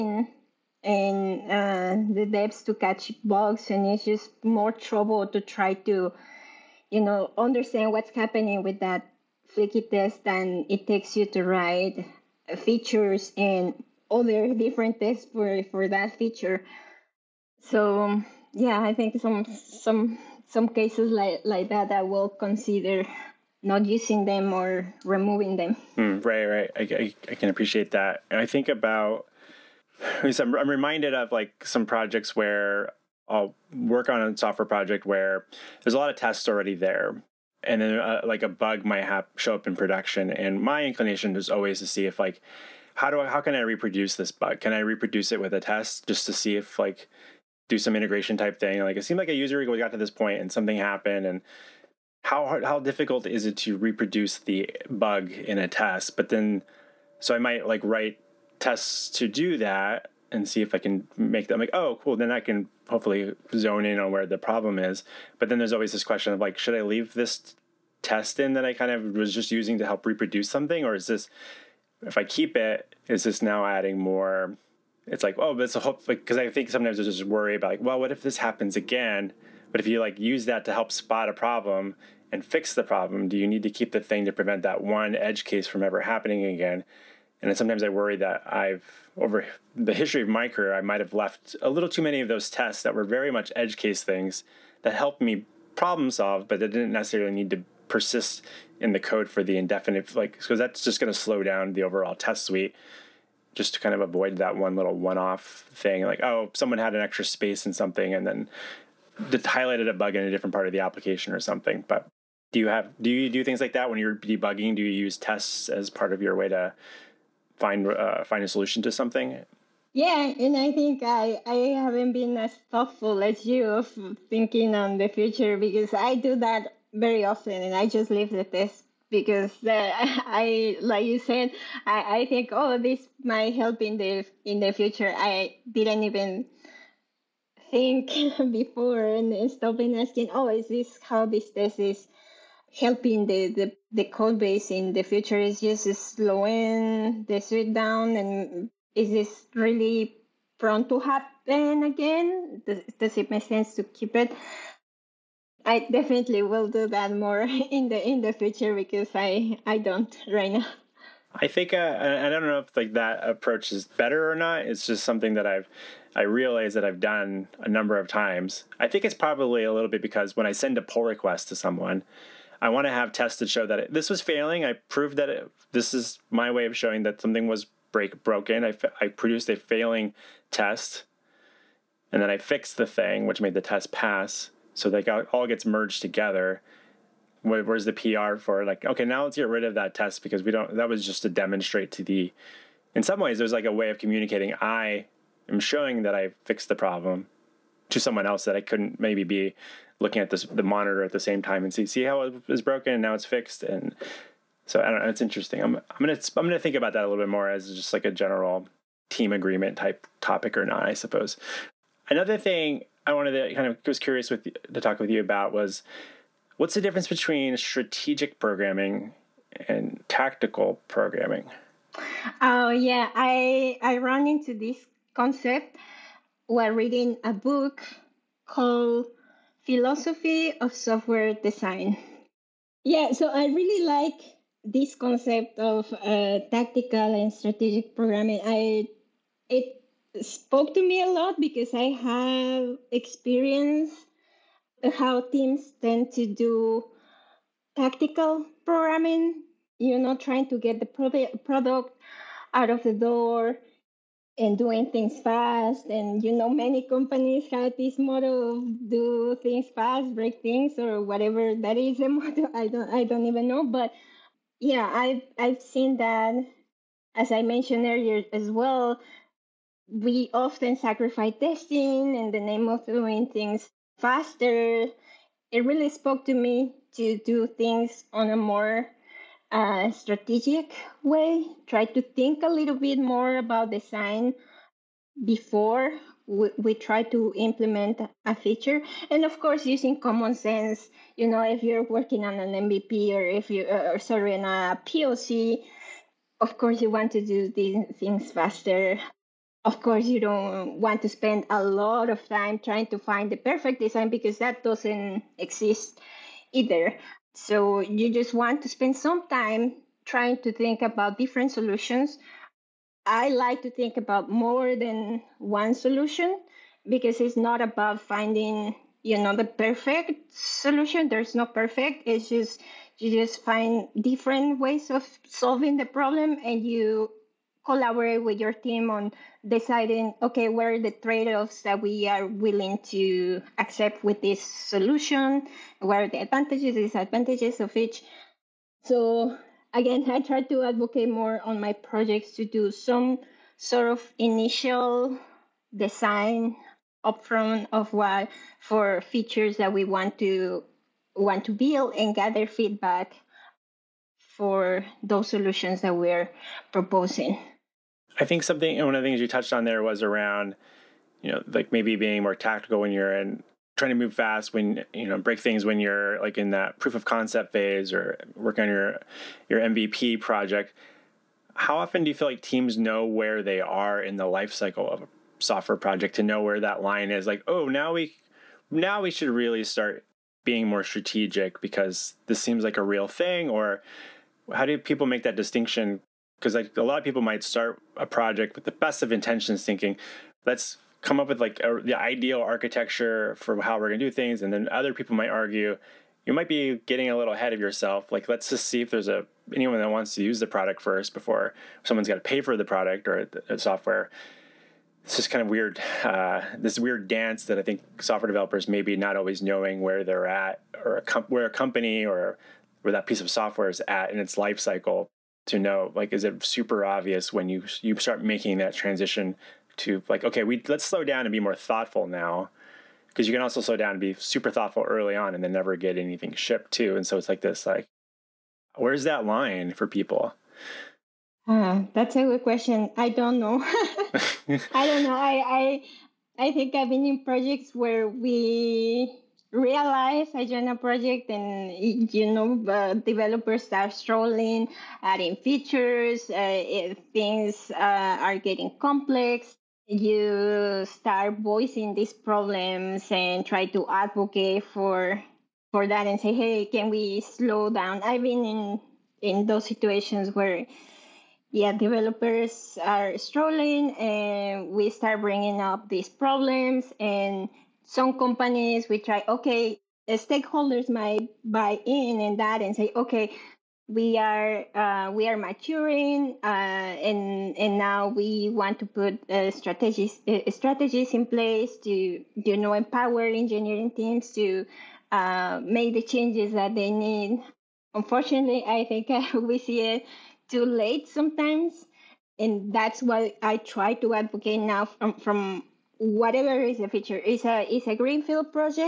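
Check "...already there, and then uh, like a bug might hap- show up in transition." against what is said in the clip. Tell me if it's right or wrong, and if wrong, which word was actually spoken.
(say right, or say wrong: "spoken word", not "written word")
wrong: "production", not "transition".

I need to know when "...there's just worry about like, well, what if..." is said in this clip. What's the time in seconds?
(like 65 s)
76 s.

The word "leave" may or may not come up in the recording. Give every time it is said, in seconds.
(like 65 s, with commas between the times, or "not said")
66 s, 128 s.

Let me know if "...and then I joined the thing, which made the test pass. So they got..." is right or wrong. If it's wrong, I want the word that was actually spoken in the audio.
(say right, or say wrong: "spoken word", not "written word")
wrong: "fixed", not "joined".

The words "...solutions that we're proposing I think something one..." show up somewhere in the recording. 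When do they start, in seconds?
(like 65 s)
355 s.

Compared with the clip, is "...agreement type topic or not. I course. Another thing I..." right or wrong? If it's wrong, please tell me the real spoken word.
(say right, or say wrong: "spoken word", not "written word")
wrong: "suppose", not "course".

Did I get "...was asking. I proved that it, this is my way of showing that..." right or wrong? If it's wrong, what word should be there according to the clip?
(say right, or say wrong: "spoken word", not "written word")
wrong: "failing", not "asking".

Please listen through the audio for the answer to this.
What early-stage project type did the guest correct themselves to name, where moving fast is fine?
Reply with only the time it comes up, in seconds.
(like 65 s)
294 s.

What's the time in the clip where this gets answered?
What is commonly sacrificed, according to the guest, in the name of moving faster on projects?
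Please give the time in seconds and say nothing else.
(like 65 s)
271 s.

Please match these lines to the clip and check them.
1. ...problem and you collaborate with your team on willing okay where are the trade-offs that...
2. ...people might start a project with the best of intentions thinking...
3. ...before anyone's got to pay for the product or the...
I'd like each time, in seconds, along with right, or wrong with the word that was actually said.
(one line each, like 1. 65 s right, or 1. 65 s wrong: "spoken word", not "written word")
1. 325 s wrong: "deciding", not "willing"
2. 387 s right
3. 401 s wrong: "someone", not "anyone".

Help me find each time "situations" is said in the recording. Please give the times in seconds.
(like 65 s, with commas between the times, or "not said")
459 s.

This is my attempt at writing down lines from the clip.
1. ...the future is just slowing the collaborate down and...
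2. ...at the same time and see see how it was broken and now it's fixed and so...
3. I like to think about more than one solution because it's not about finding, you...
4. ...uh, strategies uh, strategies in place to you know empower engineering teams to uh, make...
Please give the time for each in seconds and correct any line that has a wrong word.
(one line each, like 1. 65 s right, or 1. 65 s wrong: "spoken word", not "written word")
1. 144 s wrong: "suite", not "collaborate"
2. 201 s right
3. 313 s right
4. 479 s right.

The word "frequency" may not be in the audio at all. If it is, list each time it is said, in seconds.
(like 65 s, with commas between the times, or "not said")
not said.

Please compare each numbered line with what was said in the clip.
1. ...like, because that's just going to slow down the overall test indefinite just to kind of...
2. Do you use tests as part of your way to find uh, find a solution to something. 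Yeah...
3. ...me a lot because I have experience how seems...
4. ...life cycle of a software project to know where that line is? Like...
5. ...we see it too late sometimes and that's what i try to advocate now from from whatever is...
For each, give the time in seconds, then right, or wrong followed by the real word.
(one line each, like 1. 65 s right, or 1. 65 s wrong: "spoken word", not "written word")
1. 100 s wrong: "suite", not "indefinite"
2. 114 s right
3. 240 s wrong: "teams", not "seems"
4. 374 s right
5. 489 s right.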